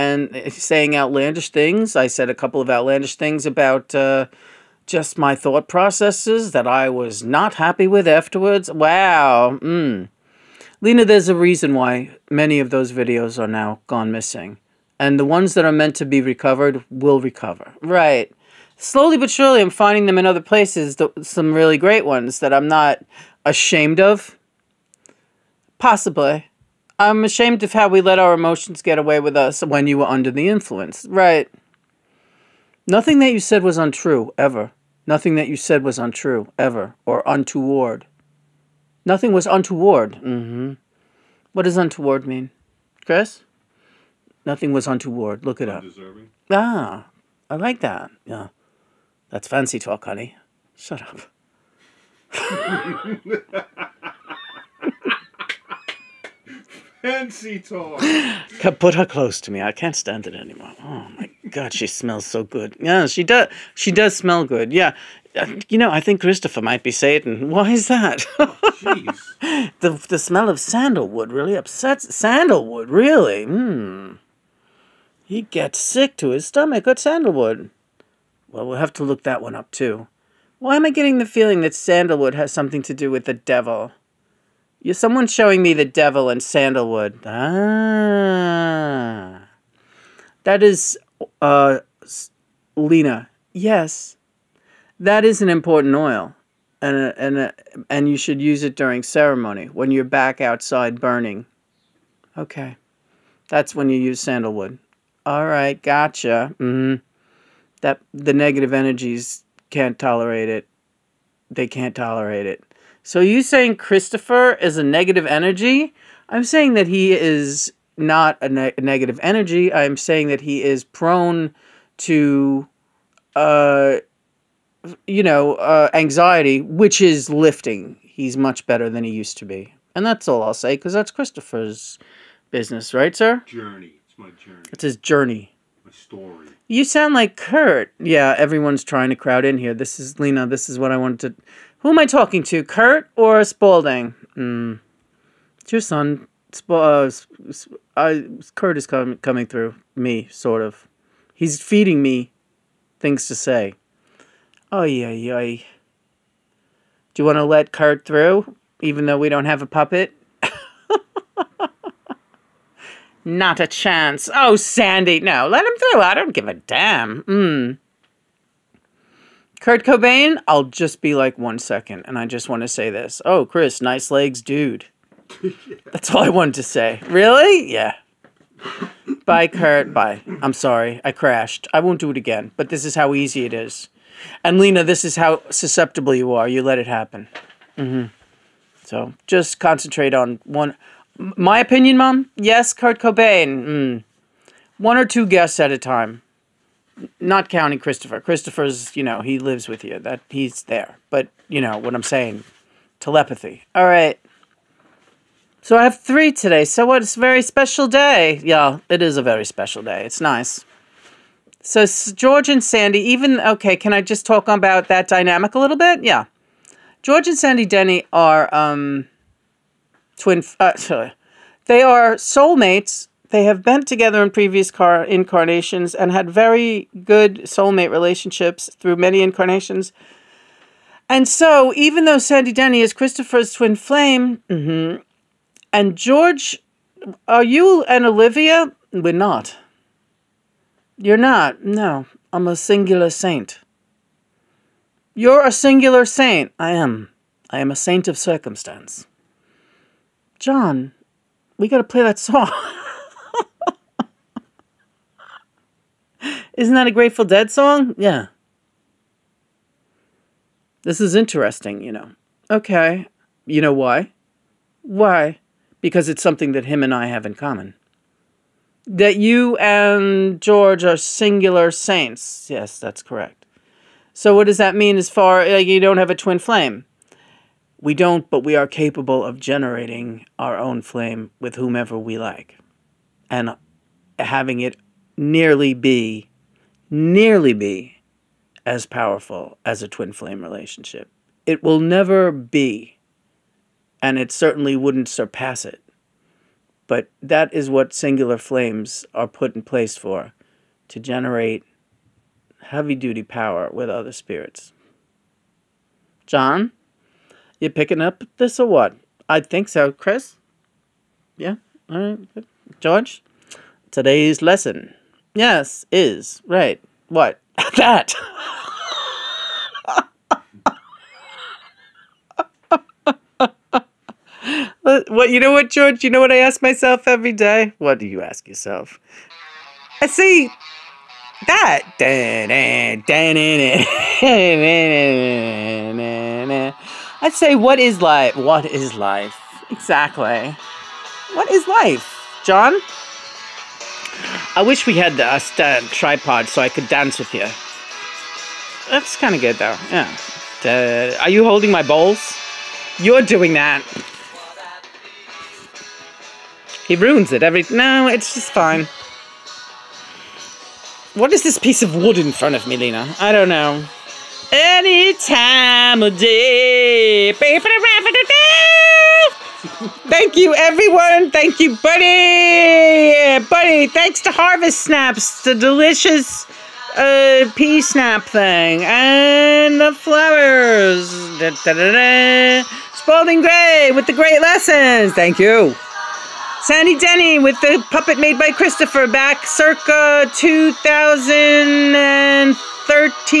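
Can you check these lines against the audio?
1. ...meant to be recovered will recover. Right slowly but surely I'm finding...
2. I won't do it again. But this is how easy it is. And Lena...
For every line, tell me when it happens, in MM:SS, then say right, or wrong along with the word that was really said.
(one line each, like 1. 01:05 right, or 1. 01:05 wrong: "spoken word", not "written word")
1. 00:15 right
2. 03:01 right.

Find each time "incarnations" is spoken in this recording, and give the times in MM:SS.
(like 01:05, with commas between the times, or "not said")
03:45, 03:49.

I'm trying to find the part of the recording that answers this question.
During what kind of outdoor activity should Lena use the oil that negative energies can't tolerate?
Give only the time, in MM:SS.
01:39.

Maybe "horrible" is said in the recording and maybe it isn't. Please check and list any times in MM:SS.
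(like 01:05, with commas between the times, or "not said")
not said.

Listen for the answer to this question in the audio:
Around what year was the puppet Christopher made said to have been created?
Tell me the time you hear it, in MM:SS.
06:30.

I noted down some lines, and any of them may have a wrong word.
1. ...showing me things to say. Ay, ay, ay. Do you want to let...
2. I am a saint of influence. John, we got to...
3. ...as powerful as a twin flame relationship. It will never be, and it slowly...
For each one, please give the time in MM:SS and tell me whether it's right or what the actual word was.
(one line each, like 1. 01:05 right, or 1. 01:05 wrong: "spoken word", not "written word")
1. 02:31 wrong: "feeding", not "showing"
2. 04:07 wrong: "circumstance", not "influence"
3. 04:48 wrong: "certainly", not "slowly".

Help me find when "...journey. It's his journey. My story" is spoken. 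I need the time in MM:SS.
02:14.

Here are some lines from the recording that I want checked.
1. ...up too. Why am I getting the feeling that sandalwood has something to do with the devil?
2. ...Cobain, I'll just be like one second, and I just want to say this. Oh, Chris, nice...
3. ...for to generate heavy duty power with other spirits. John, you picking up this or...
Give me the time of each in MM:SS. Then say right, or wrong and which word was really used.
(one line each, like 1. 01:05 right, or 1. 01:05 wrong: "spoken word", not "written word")
1. 01:19 right
2. 02:49 right
3. 04:59 right.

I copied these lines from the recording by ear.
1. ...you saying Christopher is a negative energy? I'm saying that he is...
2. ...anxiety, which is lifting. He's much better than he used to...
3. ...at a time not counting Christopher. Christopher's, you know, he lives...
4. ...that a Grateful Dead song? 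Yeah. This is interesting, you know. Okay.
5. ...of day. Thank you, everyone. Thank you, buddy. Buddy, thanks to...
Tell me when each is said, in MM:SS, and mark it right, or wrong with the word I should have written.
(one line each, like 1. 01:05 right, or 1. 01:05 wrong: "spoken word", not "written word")
1. 01:53 right
2. 02:05 right
3. 03:15 right
4. 04:16 right
5. 06:06 right.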